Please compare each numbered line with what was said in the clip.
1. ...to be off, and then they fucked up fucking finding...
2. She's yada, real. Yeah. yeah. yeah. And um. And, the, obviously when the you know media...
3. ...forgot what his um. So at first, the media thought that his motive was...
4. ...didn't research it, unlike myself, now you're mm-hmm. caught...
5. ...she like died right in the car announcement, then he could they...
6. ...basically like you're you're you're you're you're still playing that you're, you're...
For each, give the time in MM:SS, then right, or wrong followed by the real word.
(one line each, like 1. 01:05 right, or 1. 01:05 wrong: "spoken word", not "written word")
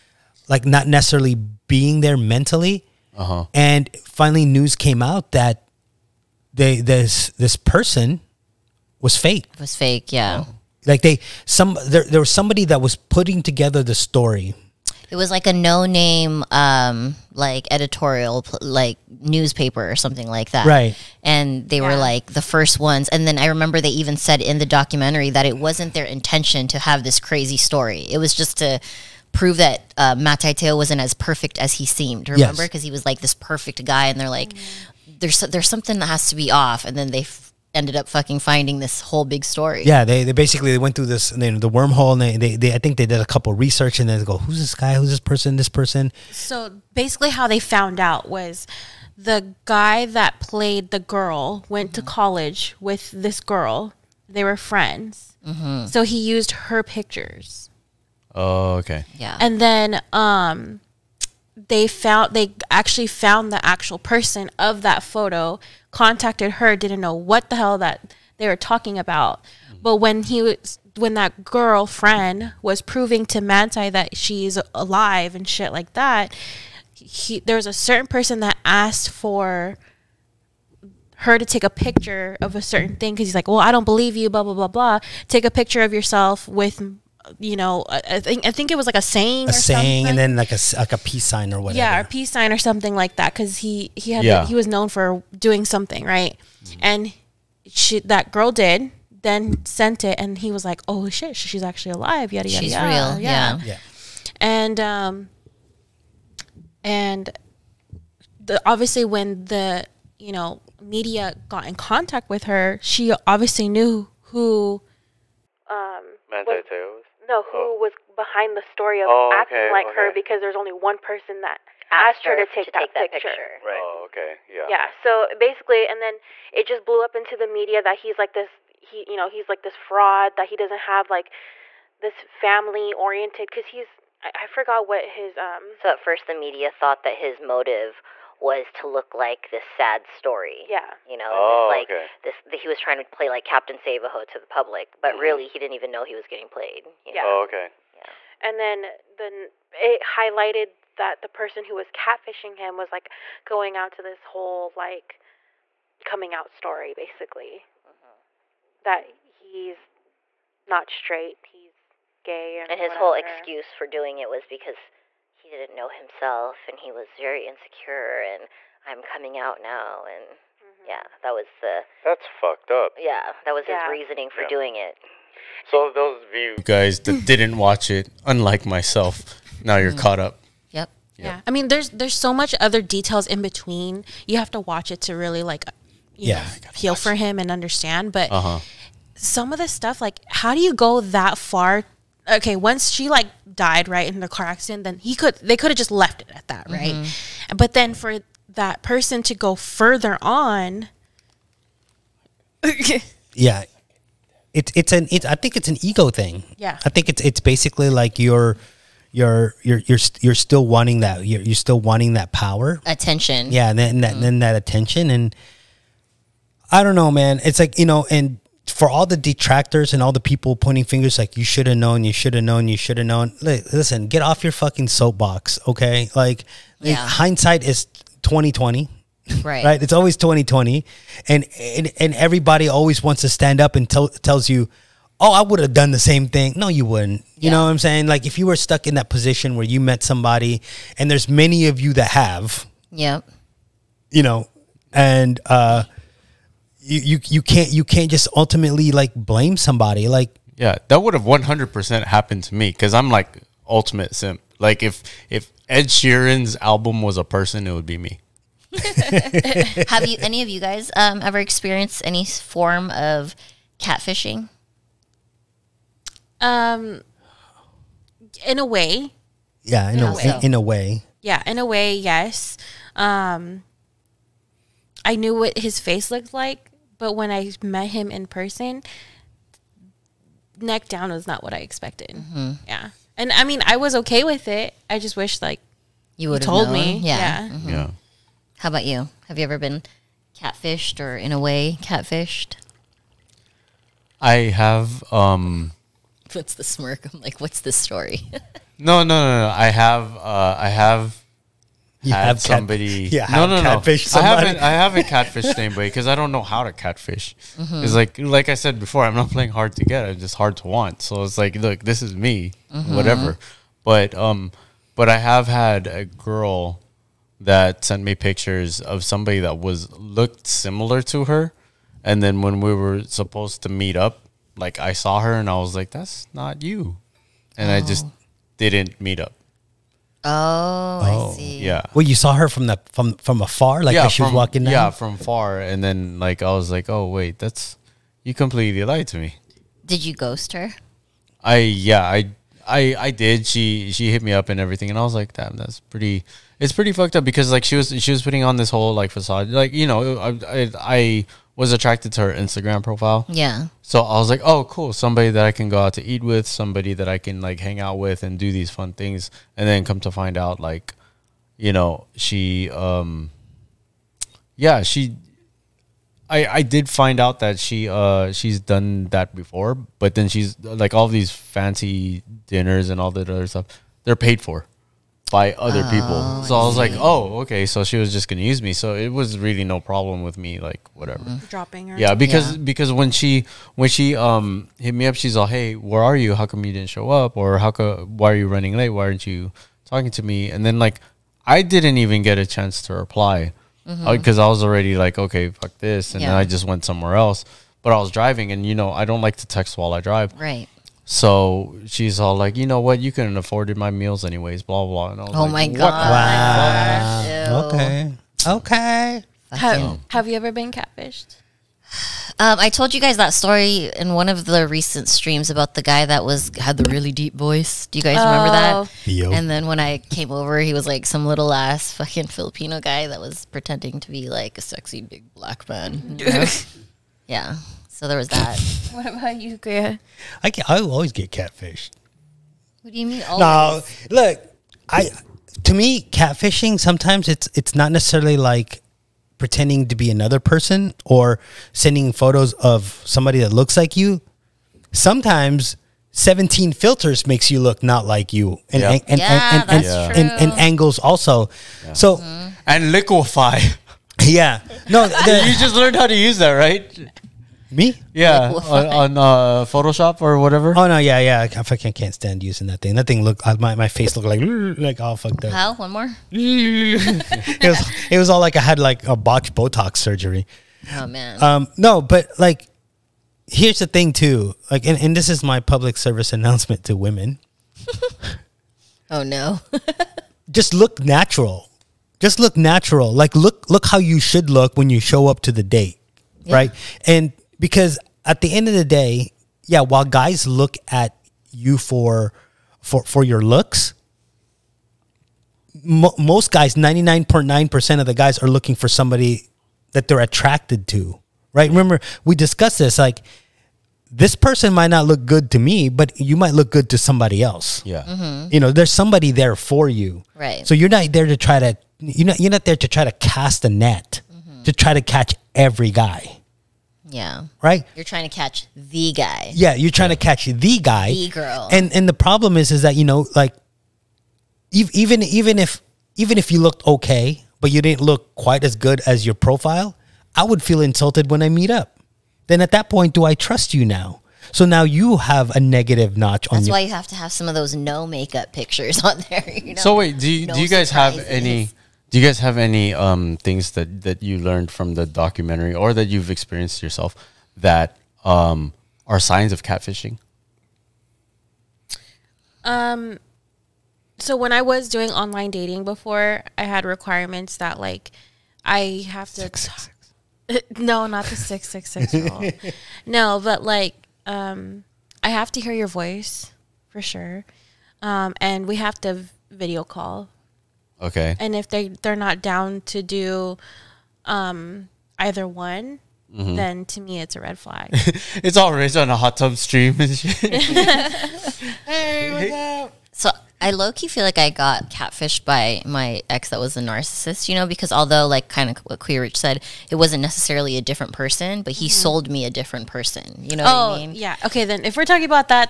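1. 00:36 wrong: "ended", not "fucked"
2. 01:42 right
3. 02:14 right
4. 02:57 wrong: "watch", not "research"
5. 03:12 wrong: "accident", not "announcement"
6. 03:27 wrong: "wanting", not "playing".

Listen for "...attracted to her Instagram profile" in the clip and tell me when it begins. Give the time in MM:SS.
05:51.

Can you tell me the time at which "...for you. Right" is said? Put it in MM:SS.
08:29.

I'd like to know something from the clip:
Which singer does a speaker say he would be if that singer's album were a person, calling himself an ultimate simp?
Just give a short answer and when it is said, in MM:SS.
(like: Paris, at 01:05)
Ed Sheeran, at 04:15.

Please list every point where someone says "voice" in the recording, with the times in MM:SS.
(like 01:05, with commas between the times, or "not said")
06:57, 09:25.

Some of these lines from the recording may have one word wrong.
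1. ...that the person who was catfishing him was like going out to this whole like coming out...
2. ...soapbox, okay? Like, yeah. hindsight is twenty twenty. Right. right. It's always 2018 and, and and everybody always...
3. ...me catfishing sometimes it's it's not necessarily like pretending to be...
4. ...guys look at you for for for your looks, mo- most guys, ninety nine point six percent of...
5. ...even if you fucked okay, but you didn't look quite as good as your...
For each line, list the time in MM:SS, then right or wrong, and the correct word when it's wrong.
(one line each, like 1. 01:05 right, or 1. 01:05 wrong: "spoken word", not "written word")
1. 02:30 right
2. 03:44 wrong: "2020", not "2018"
3. 07:15 right
4. 08:10 wrong: "nine", not "six"
5. 08:46 wrong: "looked", not "fucked".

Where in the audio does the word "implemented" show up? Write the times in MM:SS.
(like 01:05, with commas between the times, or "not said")
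not said.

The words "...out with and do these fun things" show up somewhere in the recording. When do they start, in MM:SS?
05:57.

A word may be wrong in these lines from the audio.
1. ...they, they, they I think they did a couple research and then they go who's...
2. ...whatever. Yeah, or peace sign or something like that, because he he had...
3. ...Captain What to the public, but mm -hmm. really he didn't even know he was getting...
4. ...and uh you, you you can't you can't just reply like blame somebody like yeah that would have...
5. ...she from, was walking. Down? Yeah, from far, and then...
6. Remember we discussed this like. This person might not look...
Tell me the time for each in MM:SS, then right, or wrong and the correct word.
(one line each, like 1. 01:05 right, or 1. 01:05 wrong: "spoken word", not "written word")
1. 00:42 right
2. 01:31 right
3. 02:23 wrong: "Savaho", not "What"
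4. 04:04 wrong: "ultimately", not "reply"
5. 05:34 right
6. 08:21 right.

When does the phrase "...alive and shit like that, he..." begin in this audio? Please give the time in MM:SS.
01:14.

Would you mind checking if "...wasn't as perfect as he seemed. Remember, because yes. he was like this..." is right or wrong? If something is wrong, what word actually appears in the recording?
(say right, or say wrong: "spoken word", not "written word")
right.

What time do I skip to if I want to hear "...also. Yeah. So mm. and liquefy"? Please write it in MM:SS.
07:30.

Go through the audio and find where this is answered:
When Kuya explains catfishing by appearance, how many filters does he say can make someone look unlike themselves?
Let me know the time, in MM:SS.
07:26.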